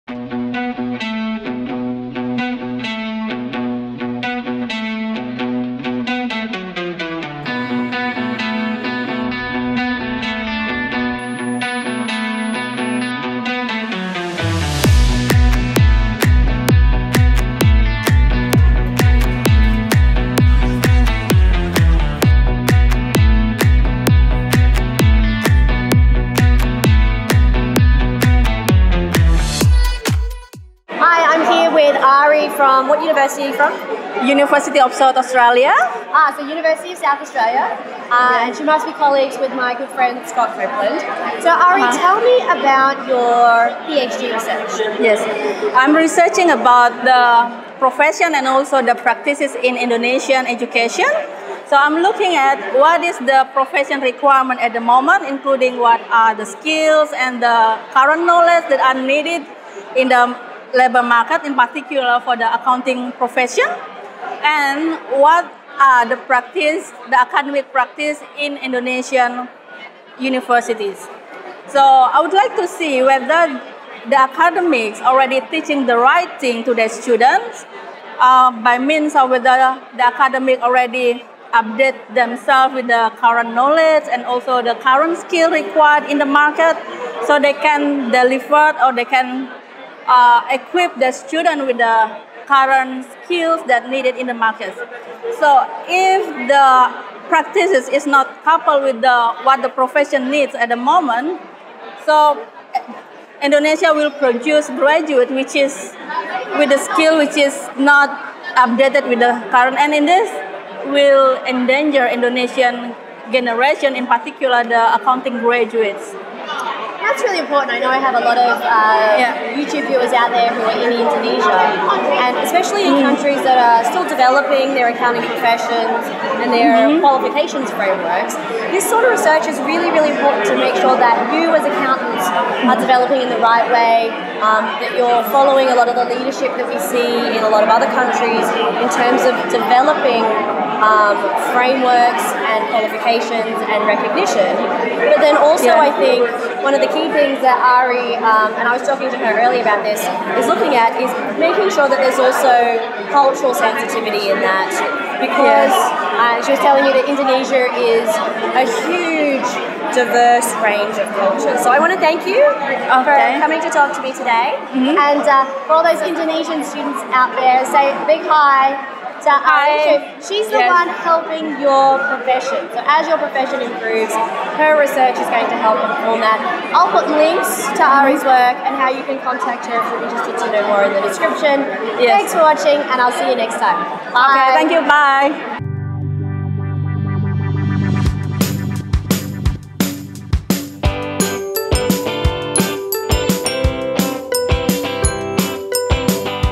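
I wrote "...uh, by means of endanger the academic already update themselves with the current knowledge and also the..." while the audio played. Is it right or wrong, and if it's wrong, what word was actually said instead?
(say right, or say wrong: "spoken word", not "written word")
wrong: "whether", not "endanger".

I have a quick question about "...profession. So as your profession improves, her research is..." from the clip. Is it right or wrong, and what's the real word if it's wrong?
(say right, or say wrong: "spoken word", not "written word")
right.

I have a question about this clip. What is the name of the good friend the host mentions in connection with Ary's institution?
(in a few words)
Scott Copeland.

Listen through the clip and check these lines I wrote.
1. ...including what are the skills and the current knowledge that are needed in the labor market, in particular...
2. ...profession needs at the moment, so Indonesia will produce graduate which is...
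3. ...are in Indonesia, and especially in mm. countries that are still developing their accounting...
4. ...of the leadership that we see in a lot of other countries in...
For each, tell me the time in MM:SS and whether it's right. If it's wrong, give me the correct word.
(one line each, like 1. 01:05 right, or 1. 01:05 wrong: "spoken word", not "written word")
1. 00:55 right
2. 01:39 right
3. 02:00 right
4. 02:15 right.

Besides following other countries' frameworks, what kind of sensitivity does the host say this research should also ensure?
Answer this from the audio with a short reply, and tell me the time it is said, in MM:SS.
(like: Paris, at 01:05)
Cultural sensitivity, at 02:33.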